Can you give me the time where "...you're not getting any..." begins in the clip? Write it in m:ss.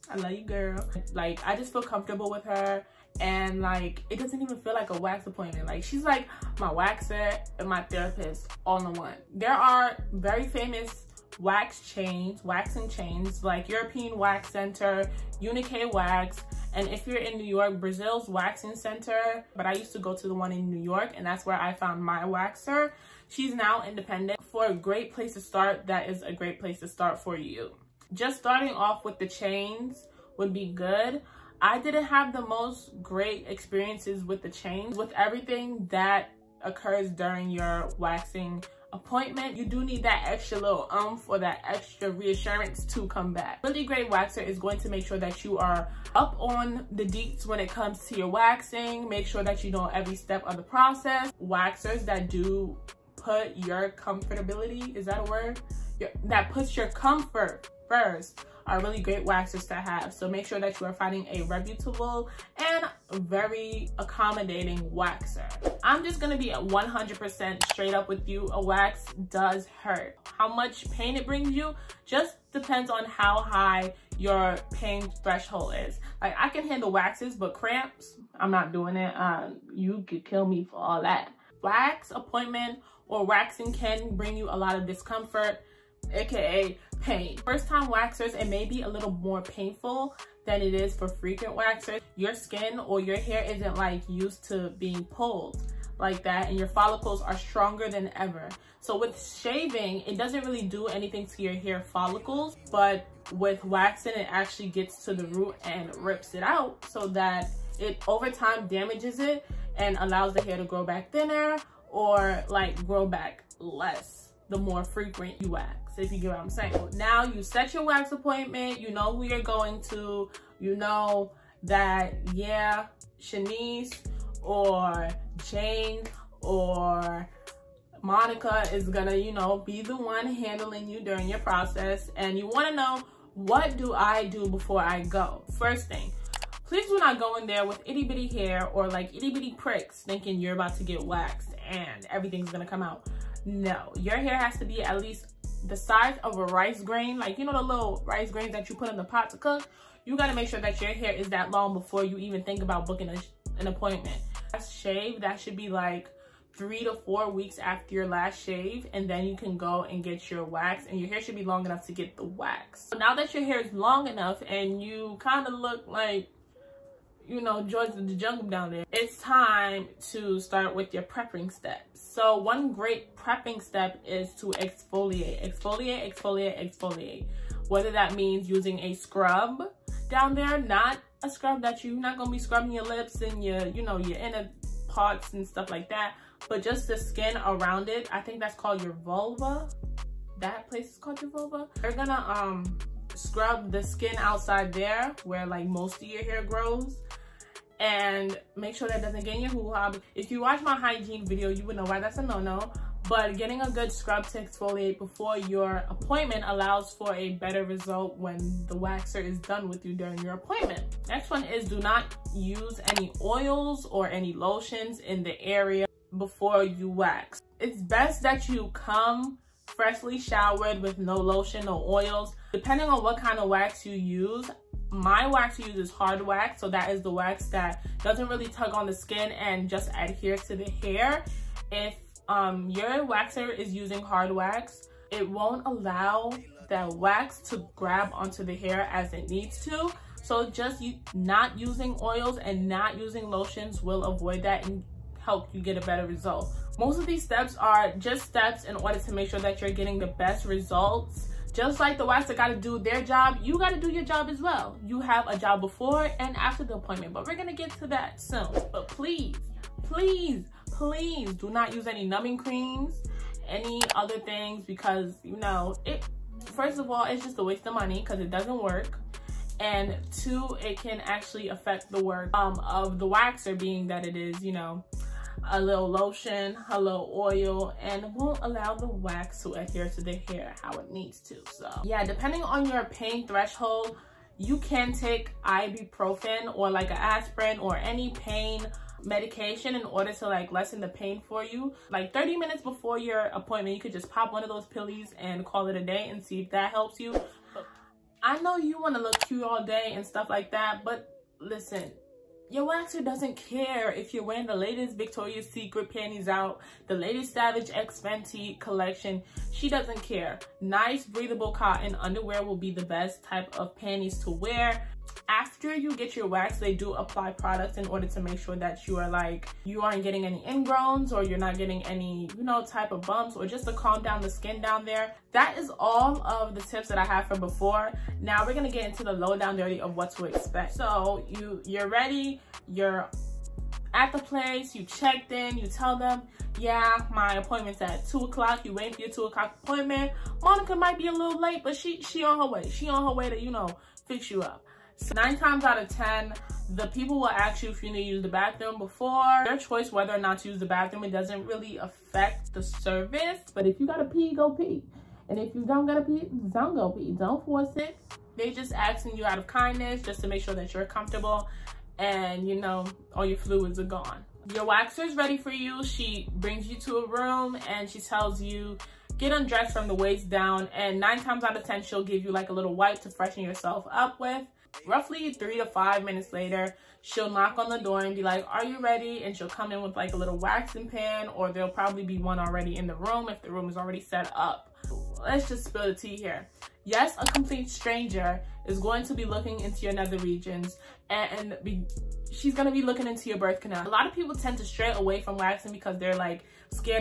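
5:21.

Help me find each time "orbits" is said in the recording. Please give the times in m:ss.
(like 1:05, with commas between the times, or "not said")
not said.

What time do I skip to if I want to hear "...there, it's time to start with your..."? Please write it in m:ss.
2:48.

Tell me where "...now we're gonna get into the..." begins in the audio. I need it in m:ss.
5:28.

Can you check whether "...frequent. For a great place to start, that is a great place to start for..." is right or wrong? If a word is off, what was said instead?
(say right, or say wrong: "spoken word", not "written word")
wrong: "independent", not "frequent".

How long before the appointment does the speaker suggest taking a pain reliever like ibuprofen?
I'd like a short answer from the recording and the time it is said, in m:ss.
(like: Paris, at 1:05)
30 minutes, at 4:52.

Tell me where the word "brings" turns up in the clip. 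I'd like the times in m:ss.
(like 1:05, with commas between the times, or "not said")
1:11, 1:24, 6:06.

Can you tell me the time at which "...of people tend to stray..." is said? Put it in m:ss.
6:34.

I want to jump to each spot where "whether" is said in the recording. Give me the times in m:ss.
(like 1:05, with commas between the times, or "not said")
2:57, 5:49.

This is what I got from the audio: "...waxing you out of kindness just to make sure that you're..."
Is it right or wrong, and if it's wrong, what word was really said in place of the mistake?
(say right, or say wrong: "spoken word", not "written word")
wrong: "asking", not "waxing".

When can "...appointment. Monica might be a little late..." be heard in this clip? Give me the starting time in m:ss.
5:39.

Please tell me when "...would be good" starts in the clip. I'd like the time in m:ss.
0:30.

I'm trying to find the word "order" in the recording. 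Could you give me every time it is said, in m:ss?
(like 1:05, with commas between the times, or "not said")
4:08, 4:49, 5:17.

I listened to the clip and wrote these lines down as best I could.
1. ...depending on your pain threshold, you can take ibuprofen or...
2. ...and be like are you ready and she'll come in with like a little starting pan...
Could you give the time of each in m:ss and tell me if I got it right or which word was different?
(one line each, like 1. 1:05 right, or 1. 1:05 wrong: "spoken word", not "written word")
1. 4:42 right
2. 6:18 wrong: "waxing", not "starting".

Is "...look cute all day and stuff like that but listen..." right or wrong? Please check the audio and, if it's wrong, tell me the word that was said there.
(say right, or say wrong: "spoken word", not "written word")
right.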